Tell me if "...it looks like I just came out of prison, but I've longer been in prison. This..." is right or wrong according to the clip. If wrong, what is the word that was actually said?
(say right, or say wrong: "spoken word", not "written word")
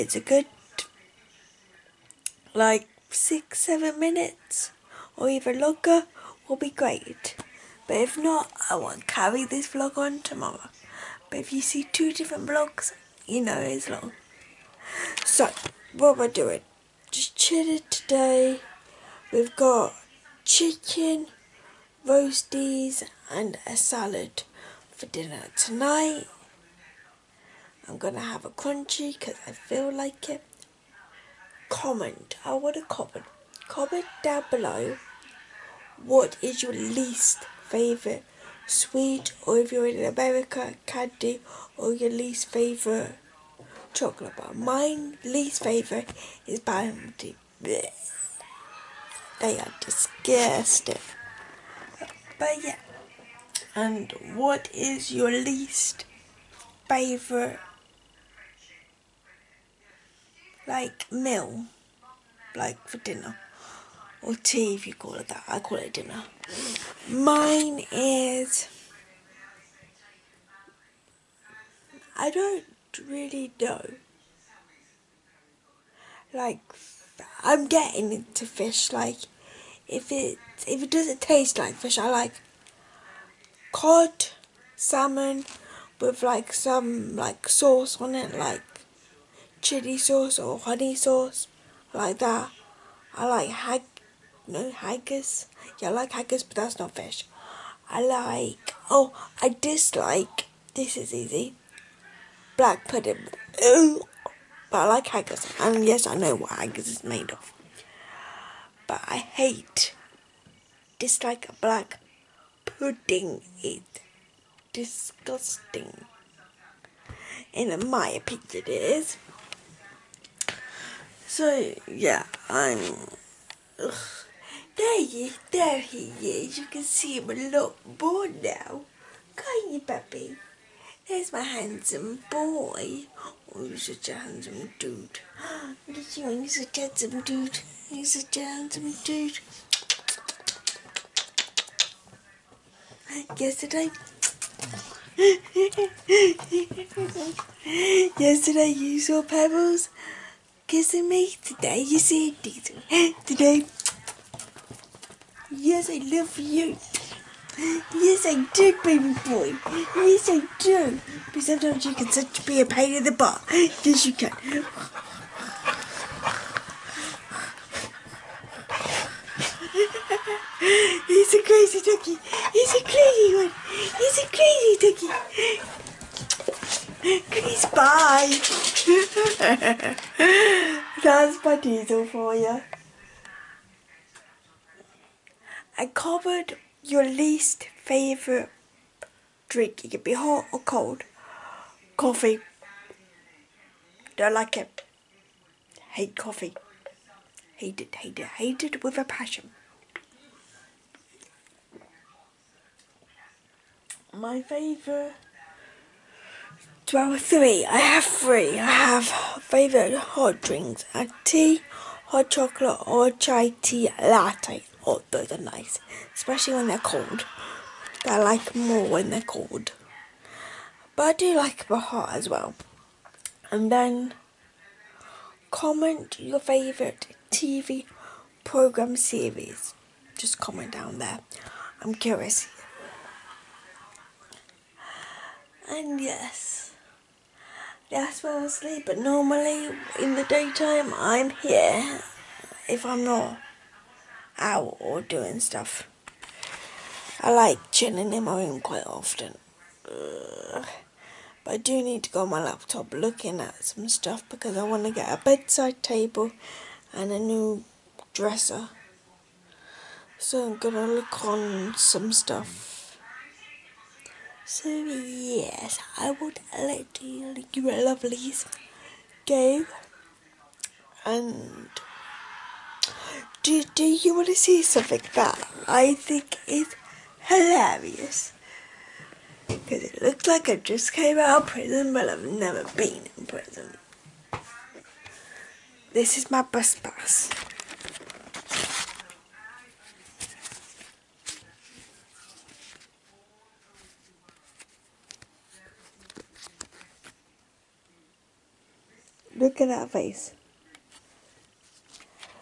wrong: "never", not "longer".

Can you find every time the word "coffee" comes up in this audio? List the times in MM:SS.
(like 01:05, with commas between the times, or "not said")
03:11, 03:16.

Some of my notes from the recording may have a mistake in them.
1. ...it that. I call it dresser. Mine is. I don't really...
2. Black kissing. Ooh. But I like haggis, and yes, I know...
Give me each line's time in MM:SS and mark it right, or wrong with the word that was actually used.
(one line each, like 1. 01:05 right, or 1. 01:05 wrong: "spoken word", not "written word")
1. 01:05 wrong: "dinner", not "dresser"
2. 01:42 wrong: "pudding", not "kissing".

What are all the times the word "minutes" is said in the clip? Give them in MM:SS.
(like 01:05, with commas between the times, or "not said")
00:03.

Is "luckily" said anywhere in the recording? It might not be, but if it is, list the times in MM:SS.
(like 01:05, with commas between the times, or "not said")
not said.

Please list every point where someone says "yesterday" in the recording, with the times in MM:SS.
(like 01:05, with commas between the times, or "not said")
02:23, 02:28.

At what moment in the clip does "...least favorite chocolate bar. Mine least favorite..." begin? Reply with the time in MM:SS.
00:42.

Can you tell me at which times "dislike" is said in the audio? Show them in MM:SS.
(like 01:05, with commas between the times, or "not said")
01:39, 01:50.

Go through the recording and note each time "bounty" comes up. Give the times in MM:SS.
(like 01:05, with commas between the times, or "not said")
00:46.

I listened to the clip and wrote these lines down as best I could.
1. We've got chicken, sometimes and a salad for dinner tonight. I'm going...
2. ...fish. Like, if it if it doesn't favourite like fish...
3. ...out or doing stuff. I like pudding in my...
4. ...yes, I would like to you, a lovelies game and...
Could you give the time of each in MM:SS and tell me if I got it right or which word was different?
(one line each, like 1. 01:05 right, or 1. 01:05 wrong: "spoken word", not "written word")
1. 00:19 wrong: "roasties", not "sometimes"
2. 01:18 wrong: "taste", not "favourite"
3. 04:04 wrong: "chilling", not "pudding"
4. 04:24 right.